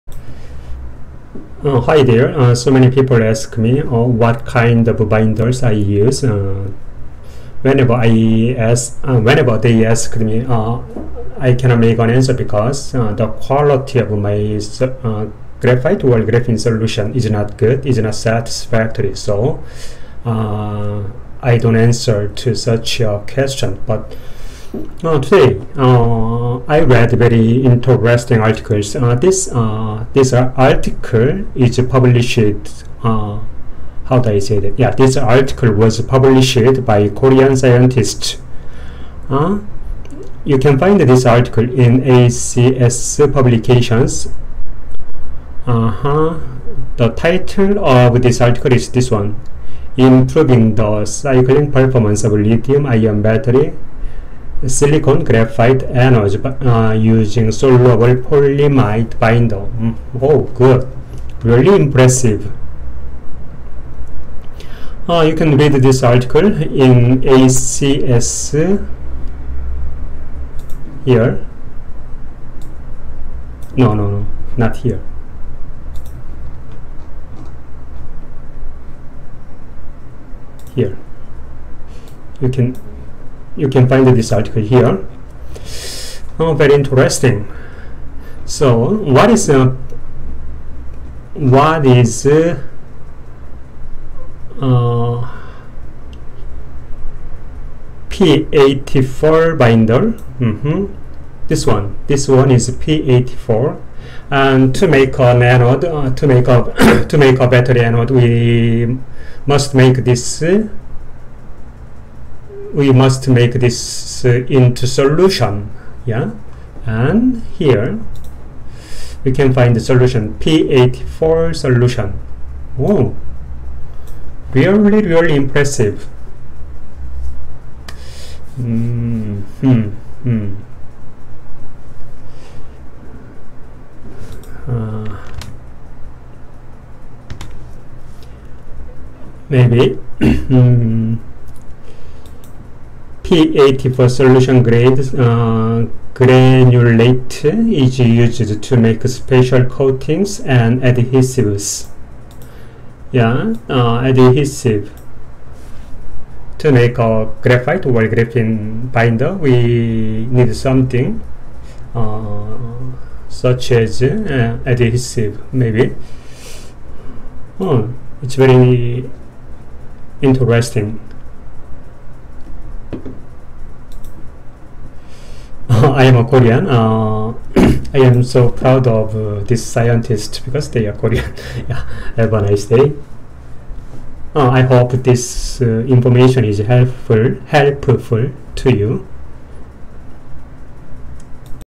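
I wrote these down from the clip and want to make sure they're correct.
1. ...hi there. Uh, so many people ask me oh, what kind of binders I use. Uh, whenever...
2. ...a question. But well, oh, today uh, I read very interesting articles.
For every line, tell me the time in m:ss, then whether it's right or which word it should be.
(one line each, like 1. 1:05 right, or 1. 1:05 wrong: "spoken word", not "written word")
1. 0:01 right
2. 0:22 right.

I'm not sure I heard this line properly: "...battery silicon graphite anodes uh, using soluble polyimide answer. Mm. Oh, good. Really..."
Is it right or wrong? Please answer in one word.
wrong.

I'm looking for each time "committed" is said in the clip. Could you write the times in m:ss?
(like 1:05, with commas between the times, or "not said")
not said.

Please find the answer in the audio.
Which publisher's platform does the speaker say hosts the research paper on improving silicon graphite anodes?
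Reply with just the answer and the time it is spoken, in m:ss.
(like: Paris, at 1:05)
ACS Publications, at 0:42.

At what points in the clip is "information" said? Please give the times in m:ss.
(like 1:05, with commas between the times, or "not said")
3:05.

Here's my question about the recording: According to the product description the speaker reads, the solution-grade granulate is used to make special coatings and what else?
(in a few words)
adhesives.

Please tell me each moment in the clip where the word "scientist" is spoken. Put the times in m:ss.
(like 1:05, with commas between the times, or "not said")
0:37, 2:59.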